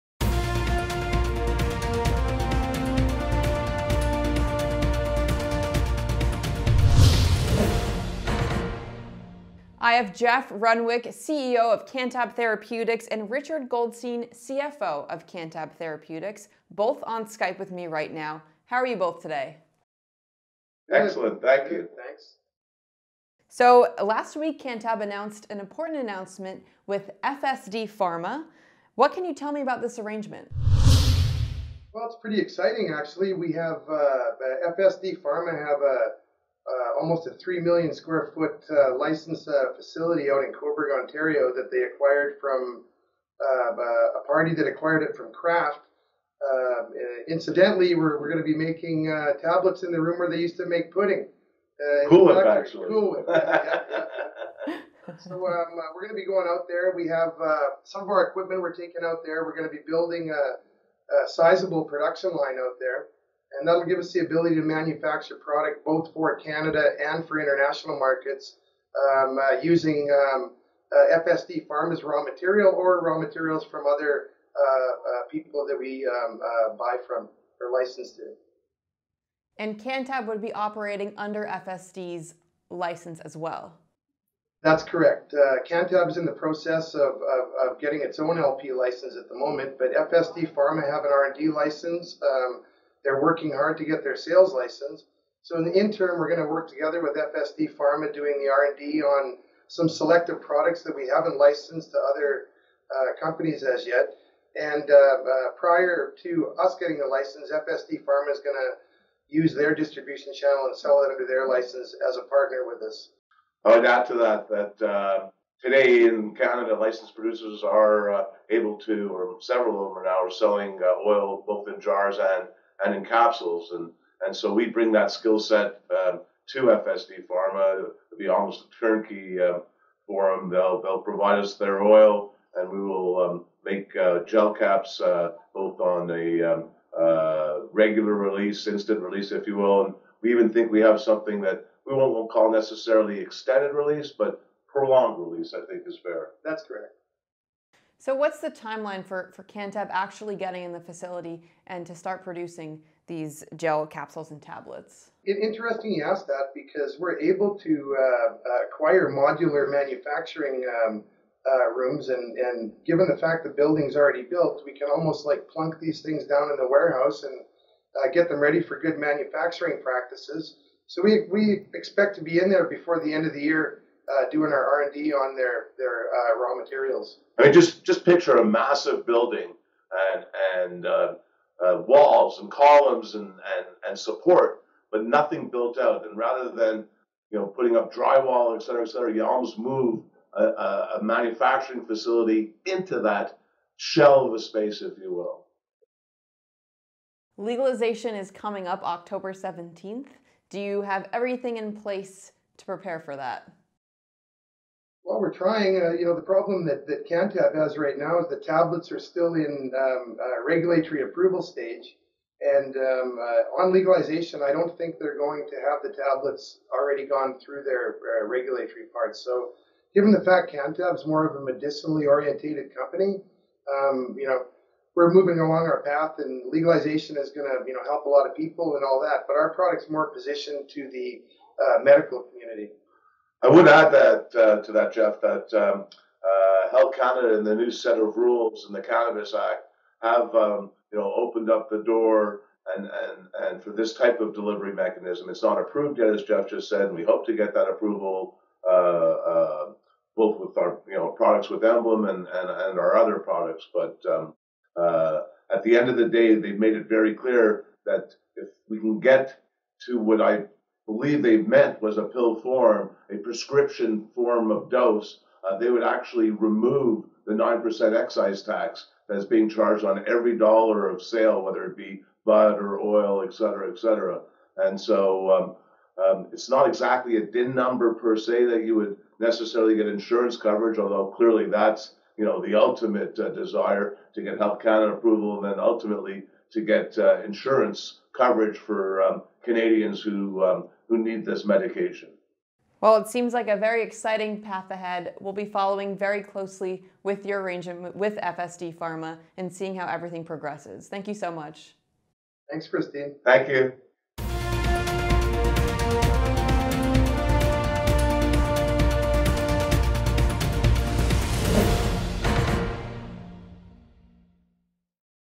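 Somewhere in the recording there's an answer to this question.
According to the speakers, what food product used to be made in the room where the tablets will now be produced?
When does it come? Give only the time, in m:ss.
0:50.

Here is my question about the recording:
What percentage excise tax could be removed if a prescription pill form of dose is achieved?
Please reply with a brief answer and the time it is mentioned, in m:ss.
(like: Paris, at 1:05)
9%, at 4:27.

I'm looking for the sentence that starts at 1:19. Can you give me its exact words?
And Canntab would be operating under FSD's license as well.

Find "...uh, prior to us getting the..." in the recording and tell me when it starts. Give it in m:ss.
1:44.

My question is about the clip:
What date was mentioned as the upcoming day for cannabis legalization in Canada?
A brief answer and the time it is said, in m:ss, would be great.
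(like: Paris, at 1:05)
October 17th, at 3:18.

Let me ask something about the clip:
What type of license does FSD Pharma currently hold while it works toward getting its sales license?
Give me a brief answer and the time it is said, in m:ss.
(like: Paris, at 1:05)
R&D license, at 1:31.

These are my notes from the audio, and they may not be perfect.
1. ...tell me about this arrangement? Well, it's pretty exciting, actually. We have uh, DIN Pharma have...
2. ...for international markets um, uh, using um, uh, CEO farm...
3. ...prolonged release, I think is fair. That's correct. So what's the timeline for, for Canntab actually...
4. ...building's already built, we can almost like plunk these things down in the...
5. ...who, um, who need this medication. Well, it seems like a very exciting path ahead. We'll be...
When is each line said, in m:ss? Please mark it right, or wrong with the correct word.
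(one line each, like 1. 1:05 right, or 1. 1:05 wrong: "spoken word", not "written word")
1. 0:29 wrong: "FSD", not "DIN"
2. 1:07 wrong: "FSD", not "CEO"
3. 2:24 right
4. 2:43 right
5. 4:50 right.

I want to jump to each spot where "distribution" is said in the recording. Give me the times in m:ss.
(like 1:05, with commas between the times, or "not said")
1:49.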